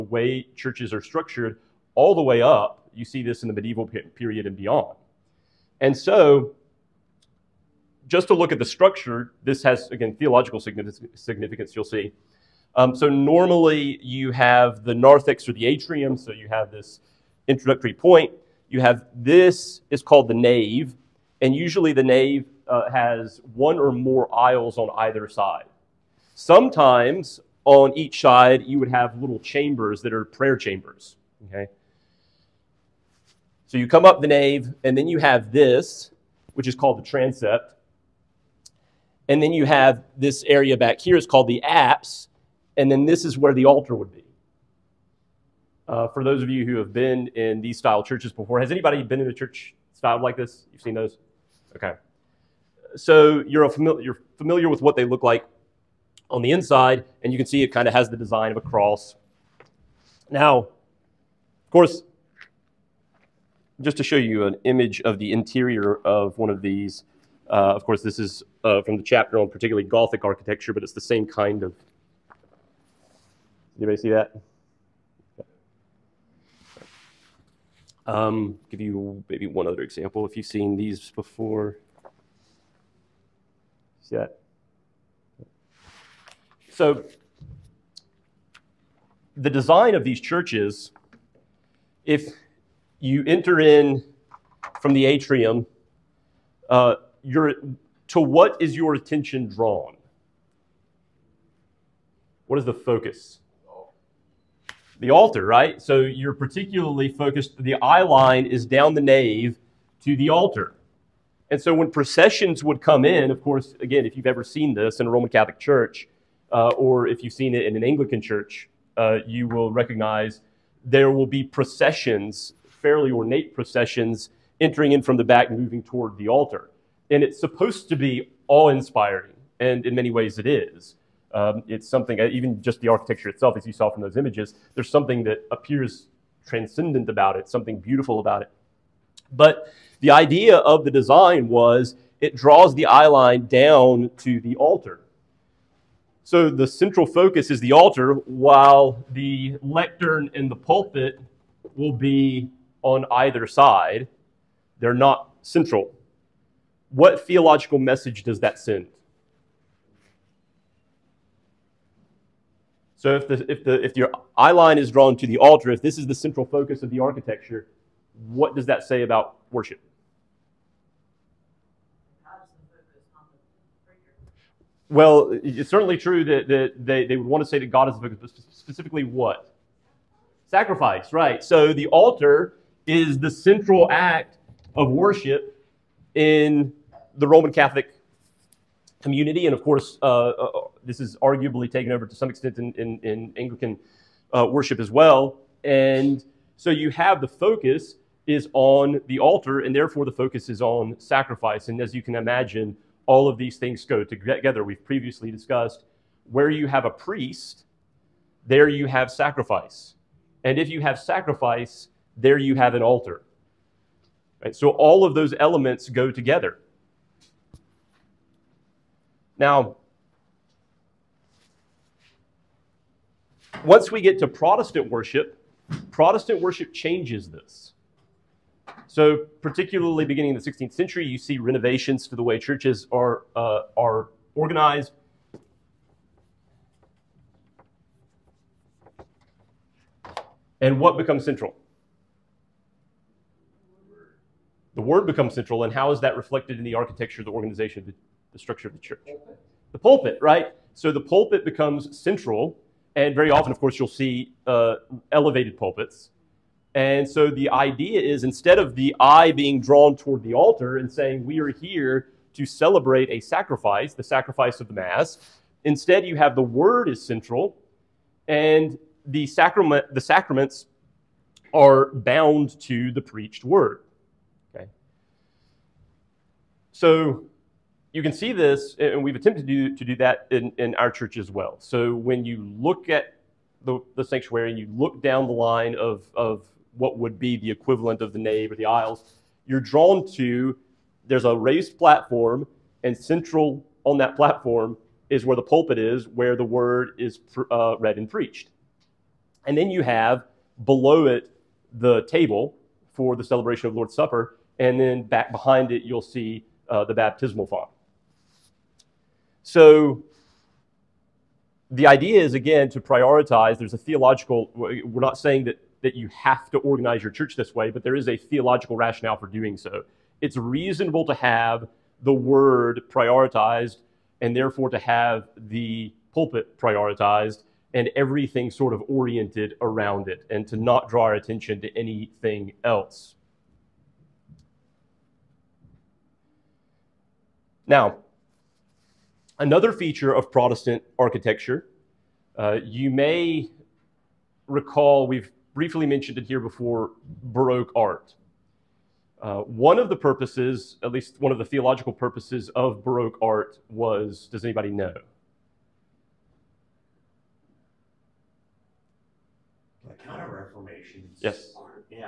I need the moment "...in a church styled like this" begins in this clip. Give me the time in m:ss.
0:49.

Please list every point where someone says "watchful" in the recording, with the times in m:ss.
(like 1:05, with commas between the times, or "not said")
not said.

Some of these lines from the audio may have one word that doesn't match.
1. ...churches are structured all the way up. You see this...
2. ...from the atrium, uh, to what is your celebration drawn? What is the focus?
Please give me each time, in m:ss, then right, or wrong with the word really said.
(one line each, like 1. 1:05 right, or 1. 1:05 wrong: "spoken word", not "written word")
1. 0:00 right
2. 1:34 wrong: "attention", not "celebration".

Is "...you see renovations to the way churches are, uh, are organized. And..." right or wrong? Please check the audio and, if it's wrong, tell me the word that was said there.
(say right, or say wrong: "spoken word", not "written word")
right.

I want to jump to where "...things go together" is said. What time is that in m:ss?
3:23.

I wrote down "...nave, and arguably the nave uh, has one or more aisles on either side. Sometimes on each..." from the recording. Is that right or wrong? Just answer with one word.
wrong.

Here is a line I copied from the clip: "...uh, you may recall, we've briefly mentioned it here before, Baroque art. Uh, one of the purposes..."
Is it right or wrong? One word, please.
right.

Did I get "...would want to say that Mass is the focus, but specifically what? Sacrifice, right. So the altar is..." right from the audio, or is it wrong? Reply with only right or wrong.
wrong.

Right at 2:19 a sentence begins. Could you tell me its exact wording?
But the idea of the design was it draws the eye line down to the altar.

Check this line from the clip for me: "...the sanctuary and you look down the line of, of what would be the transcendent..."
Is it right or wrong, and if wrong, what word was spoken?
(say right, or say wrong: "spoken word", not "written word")
wrong: "equivalent", not "transcendent".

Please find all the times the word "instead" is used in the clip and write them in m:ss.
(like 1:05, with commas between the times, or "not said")
4:18, 4:25.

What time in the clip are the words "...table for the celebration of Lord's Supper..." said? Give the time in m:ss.
5:02.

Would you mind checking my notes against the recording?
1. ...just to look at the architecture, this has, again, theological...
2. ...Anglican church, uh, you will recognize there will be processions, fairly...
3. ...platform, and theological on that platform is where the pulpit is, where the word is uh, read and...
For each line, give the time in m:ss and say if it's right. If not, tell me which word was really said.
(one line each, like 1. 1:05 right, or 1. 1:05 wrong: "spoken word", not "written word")
1. 0:08 wrong: "structure", not "architecture"
2. 1:57 right
3. 4:51 wrong: "central", not "theological".